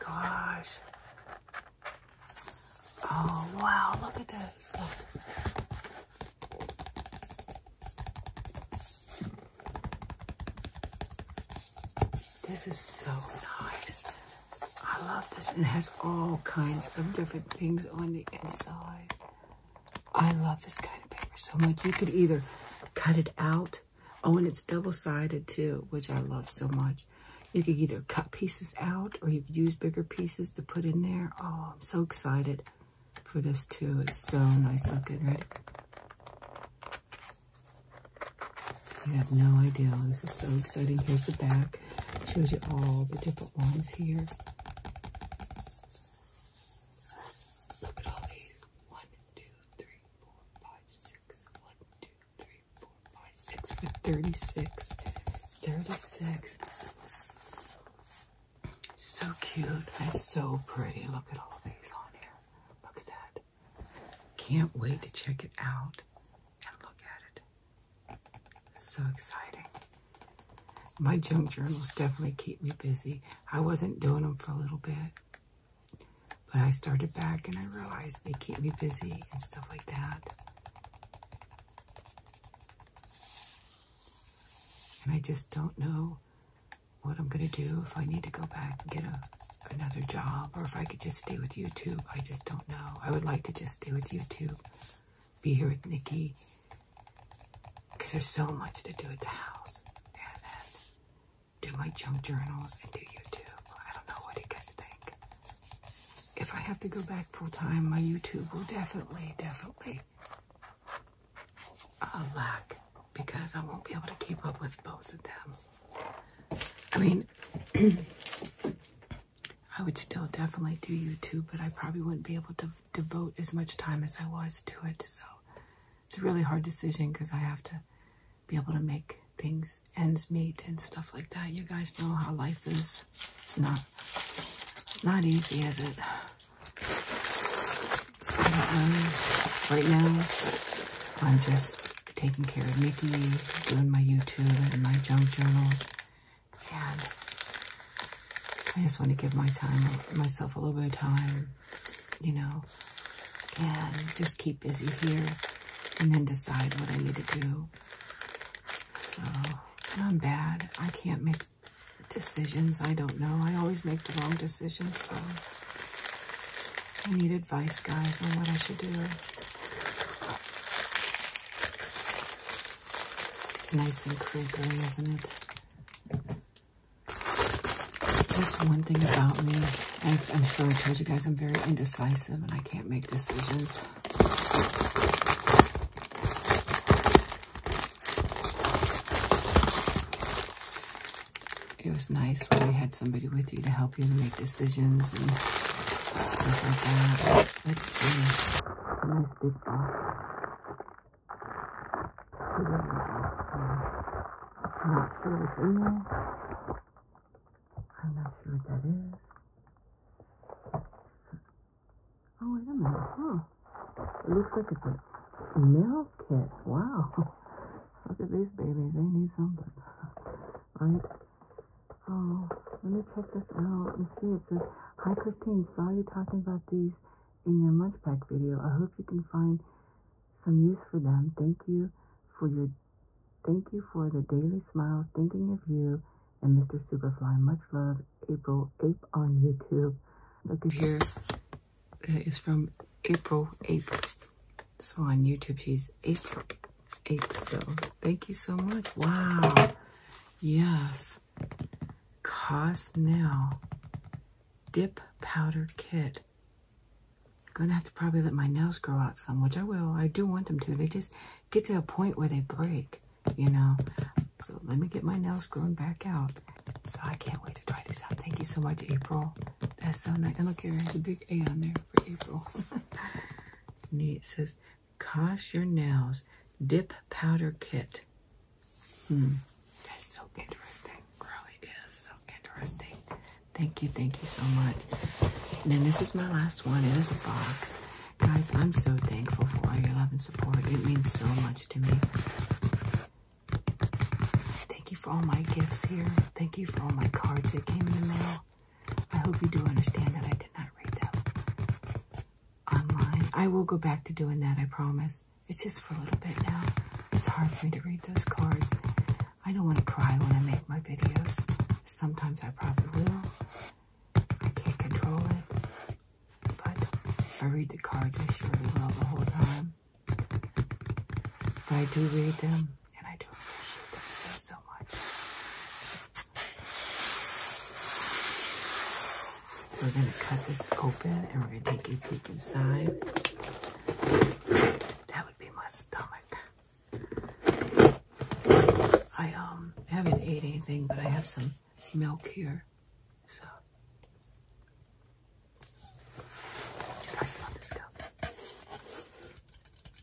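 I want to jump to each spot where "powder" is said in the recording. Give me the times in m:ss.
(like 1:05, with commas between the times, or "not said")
4:15, 4:37.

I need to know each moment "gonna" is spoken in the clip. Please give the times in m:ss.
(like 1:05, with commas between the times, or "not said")
1:27, 4:17.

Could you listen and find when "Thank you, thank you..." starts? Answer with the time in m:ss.
4:43.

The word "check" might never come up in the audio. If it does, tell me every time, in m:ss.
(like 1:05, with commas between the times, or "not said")
1:05, 3:43.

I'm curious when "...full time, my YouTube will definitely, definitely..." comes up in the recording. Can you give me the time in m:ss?
1:47.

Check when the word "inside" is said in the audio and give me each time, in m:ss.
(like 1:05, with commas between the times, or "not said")
0:18, 5:32.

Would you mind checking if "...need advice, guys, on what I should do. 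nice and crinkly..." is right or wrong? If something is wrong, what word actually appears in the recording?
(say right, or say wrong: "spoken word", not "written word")
right.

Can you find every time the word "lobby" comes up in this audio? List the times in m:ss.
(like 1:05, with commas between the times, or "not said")
not said.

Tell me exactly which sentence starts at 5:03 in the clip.
I will go back to doing that, I promise.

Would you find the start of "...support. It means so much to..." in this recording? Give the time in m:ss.
4:50.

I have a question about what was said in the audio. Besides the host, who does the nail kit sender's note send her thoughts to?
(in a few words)
Mr. Superfly.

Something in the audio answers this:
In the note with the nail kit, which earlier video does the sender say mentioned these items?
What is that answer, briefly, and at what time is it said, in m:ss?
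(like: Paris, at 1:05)
Munch Pack video, at 3:47.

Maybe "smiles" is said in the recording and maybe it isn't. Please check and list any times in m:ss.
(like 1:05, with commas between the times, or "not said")
3:54.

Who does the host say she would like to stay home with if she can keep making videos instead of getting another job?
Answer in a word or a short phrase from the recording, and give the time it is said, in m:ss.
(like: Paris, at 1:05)
Nikki, at 1:35.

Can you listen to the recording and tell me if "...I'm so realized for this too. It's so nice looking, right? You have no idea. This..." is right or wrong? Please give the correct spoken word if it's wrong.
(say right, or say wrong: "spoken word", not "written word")
wrong: "excited", not "realized".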